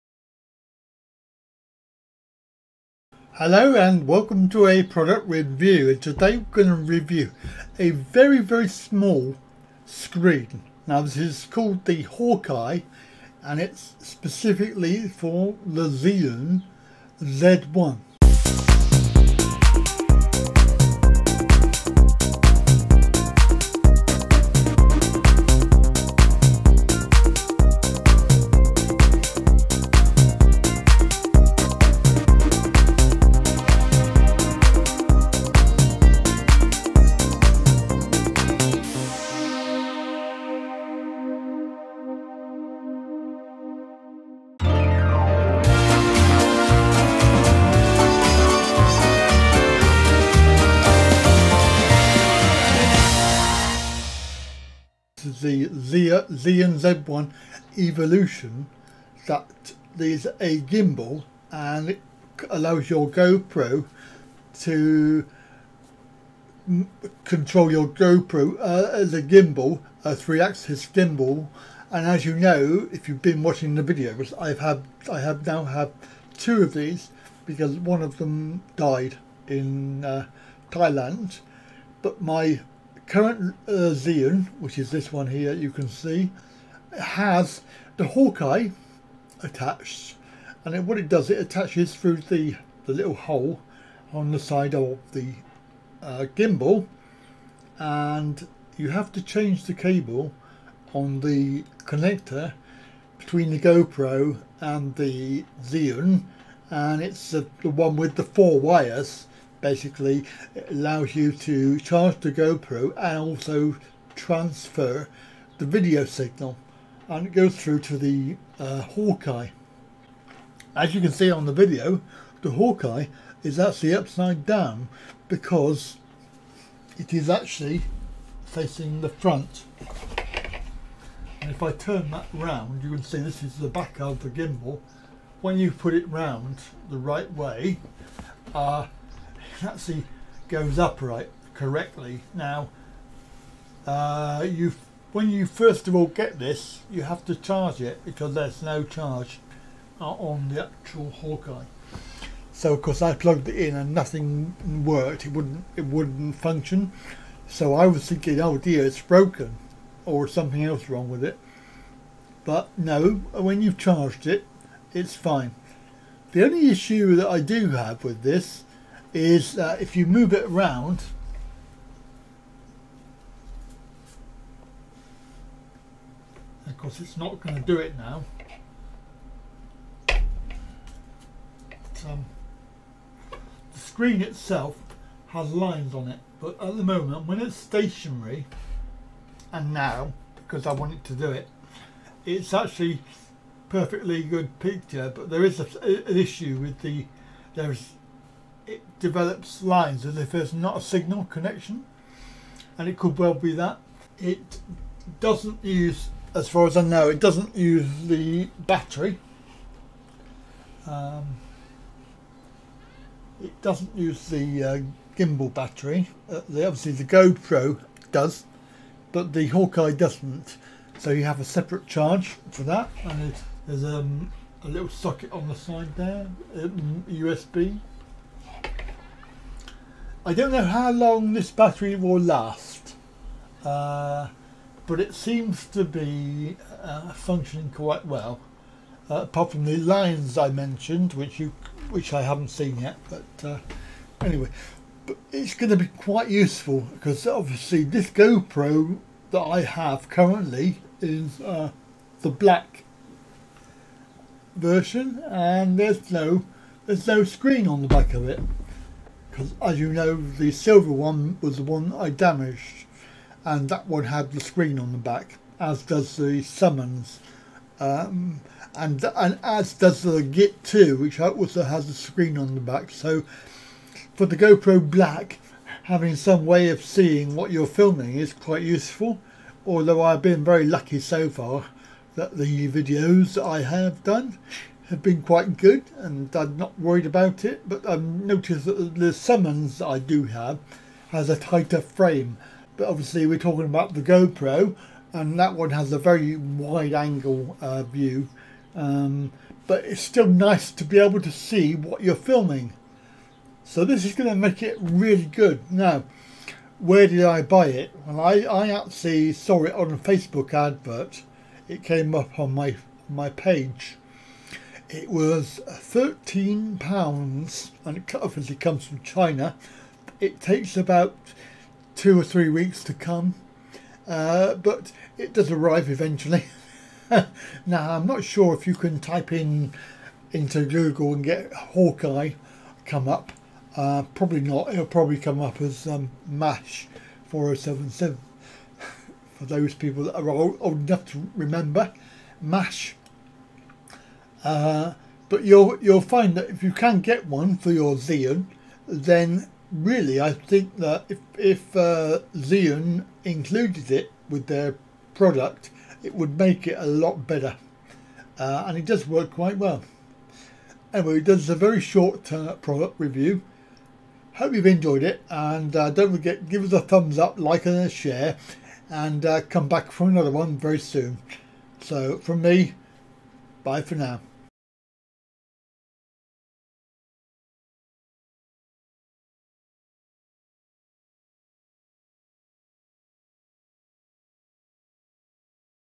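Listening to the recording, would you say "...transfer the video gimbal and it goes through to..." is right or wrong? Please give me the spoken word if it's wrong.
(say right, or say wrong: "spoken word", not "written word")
wrong: "signal", not "gimbal".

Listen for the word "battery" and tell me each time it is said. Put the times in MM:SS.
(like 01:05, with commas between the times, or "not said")
03:28, 03:35, 03:51.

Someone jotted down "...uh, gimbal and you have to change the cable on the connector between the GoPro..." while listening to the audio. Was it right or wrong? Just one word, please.
right.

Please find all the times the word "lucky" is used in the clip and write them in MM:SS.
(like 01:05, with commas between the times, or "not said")
04:40.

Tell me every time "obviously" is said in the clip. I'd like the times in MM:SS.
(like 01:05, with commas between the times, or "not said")
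03:36, 04:07, 04:52, 05:18.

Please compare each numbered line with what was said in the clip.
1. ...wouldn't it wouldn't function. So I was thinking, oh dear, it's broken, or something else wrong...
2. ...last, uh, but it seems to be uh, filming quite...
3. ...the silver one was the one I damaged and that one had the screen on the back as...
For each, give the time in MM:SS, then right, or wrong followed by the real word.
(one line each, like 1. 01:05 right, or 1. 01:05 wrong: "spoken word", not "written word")
1. 02:35 right
2. 03:52 wrong: "functioning", not "filming"
3. 04:20 right.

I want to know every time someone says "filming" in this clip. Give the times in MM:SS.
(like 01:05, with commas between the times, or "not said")
04:37, 05:02.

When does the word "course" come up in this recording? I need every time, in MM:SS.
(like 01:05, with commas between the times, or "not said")
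02:32, 02:56.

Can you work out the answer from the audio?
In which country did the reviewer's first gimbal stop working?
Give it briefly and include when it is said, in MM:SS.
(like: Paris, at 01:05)
Thailand, at 01:20.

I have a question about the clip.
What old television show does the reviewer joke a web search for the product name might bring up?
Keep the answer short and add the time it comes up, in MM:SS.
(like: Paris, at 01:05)
MASH 4077, at 05:36.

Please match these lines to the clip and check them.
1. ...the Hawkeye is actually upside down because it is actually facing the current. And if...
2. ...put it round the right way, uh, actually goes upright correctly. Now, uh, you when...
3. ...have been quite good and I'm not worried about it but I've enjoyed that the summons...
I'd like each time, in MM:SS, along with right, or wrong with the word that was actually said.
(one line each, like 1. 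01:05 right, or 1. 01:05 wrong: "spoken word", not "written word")
1. 02:02 wrong: "front", not "current"
2. 02:15 right
3. 04:44 wrong: "noticed", not "enjoyed".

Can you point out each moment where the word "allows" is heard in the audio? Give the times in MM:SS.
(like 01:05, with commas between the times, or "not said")
01:02, 01:50.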